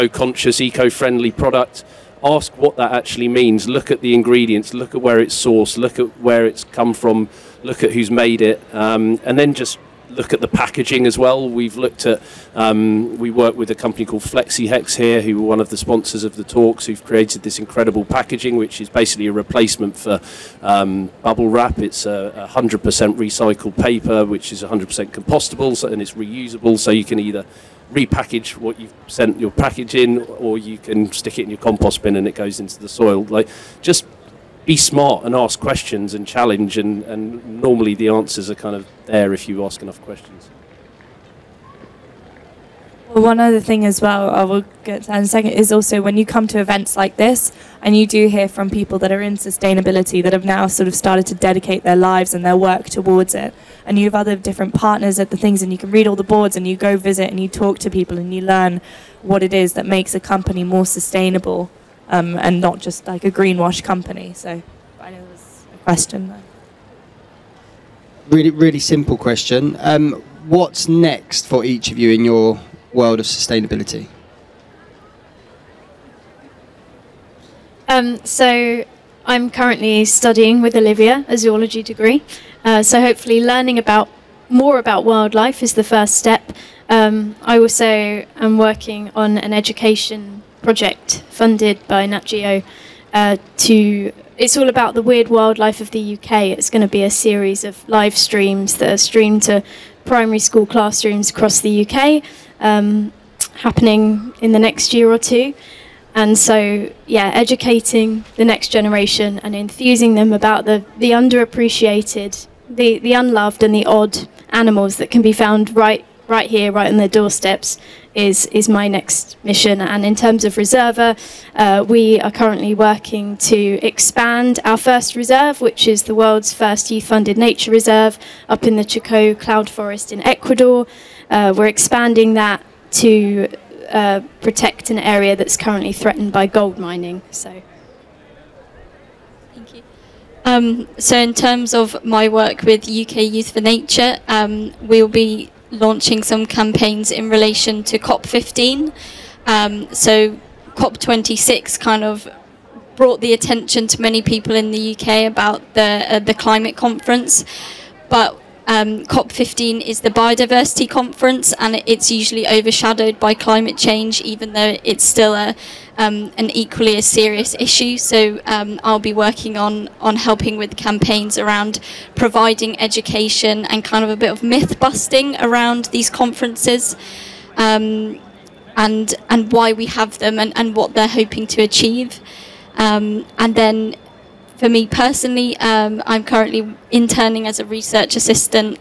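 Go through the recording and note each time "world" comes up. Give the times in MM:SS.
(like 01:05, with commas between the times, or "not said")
01:12, 02:06.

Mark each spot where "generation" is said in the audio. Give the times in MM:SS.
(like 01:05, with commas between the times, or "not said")
01:48.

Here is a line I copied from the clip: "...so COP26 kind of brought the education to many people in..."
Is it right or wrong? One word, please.
wrong.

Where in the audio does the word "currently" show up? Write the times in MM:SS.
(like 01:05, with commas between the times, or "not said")
01:19, 02:02, 02:15, 03:06.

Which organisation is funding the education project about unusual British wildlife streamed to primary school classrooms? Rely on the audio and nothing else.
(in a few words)
Nat Geo.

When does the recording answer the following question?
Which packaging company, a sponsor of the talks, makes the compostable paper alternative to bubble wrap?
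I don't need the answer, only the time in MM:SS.
00:14.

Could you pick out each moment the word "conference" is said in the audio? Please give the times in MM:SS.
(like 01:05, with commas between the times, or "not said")
02:36, 02:40, 02:56.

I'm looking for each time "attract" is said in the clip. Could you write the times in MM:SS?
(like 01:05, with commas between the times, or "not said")
not said.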